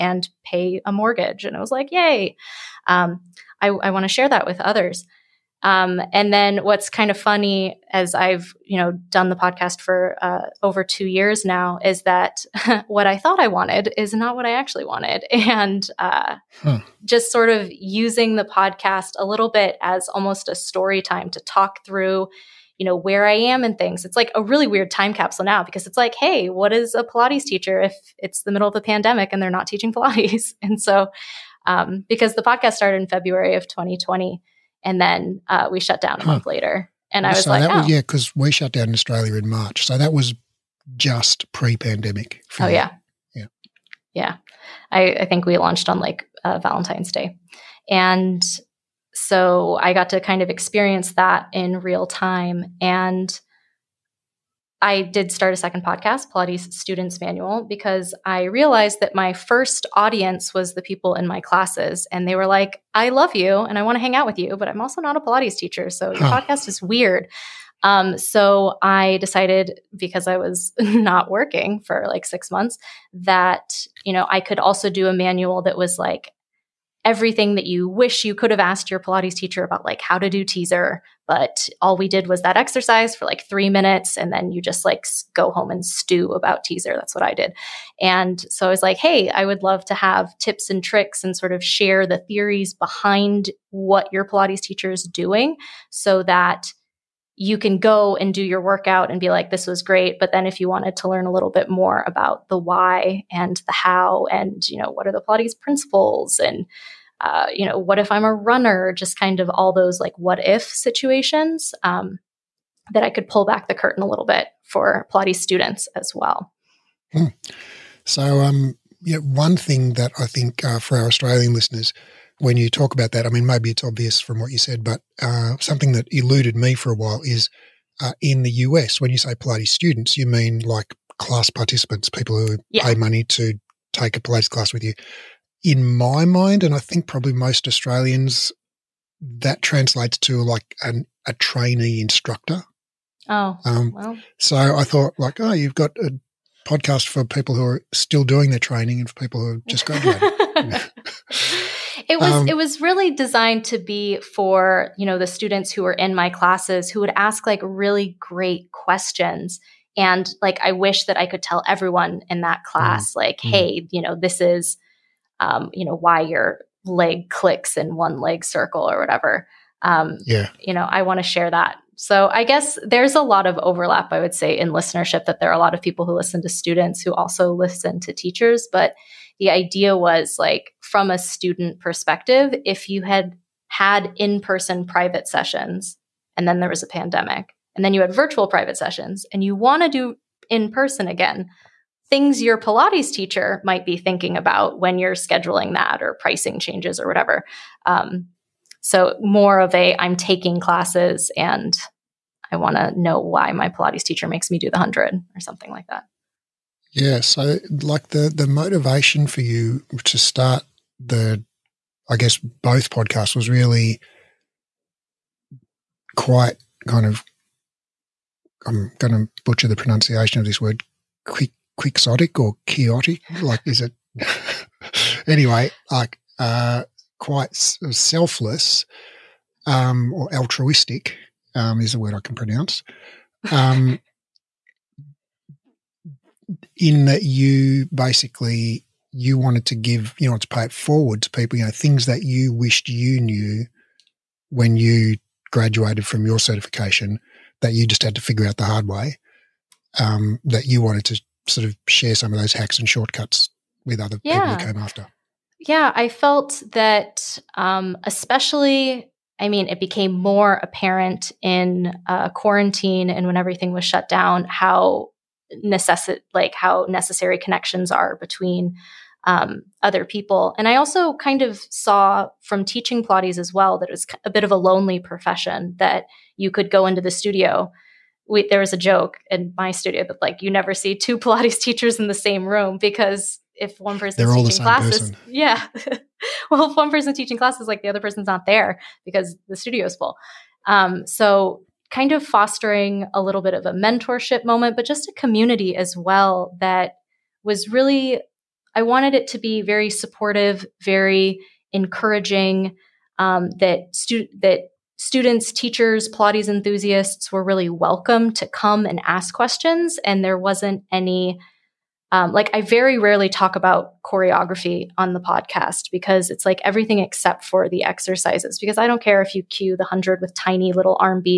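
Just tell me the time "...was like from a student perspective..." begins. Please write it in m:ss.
2:59.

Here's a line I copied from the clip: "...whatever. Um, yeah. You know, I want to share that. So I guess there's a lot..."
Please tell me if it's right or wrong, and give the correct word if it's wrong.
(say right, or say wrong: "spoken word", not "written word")
right.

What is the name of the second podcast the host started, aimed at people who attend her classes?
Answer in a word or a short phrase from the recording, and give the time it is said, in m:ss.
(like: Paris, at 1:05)
Pilates Students Manual, at 0:56.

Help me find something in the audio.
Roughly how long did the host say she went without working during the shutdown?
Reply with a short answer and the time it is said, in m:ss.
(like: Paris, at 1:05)
6 months, at 1:12.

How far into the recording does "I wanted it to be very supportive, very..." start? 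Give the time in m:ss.
4:58.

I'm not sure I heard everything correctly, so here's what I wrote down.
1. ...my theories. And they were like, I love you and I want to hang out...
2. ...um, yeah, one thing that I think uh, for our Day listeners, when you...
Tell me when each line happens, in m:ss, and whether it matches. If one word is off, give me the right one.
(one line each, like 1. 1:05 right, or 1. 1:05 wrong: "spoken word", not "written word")
1. 1:01 wrong: "classes", not "theories"
2. 1:58 wrong: "Australian", not "Day".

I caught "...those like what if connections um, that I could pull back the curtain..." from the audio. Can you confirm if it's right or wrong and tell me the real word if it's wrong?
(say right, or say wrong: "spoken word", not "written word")
wrong: "situations", not "connections".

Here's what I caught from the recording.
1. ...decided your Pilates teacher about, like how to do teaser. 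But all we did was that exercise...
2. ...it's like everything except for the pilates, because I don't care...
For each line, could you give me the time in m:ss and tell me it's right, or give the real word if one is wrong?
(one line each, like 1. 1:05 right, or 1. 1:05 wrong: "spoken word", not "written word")
1. 1:18 wrong: "asked", not "decided"
2. 5:16 wrong: "exercises", not "pilates".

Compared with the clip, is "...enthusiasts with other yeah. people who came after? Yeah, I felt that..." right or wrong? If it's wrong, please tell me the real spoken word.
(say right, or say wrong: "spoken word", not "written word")
wrong: "shortcuts", not "enthusiasts".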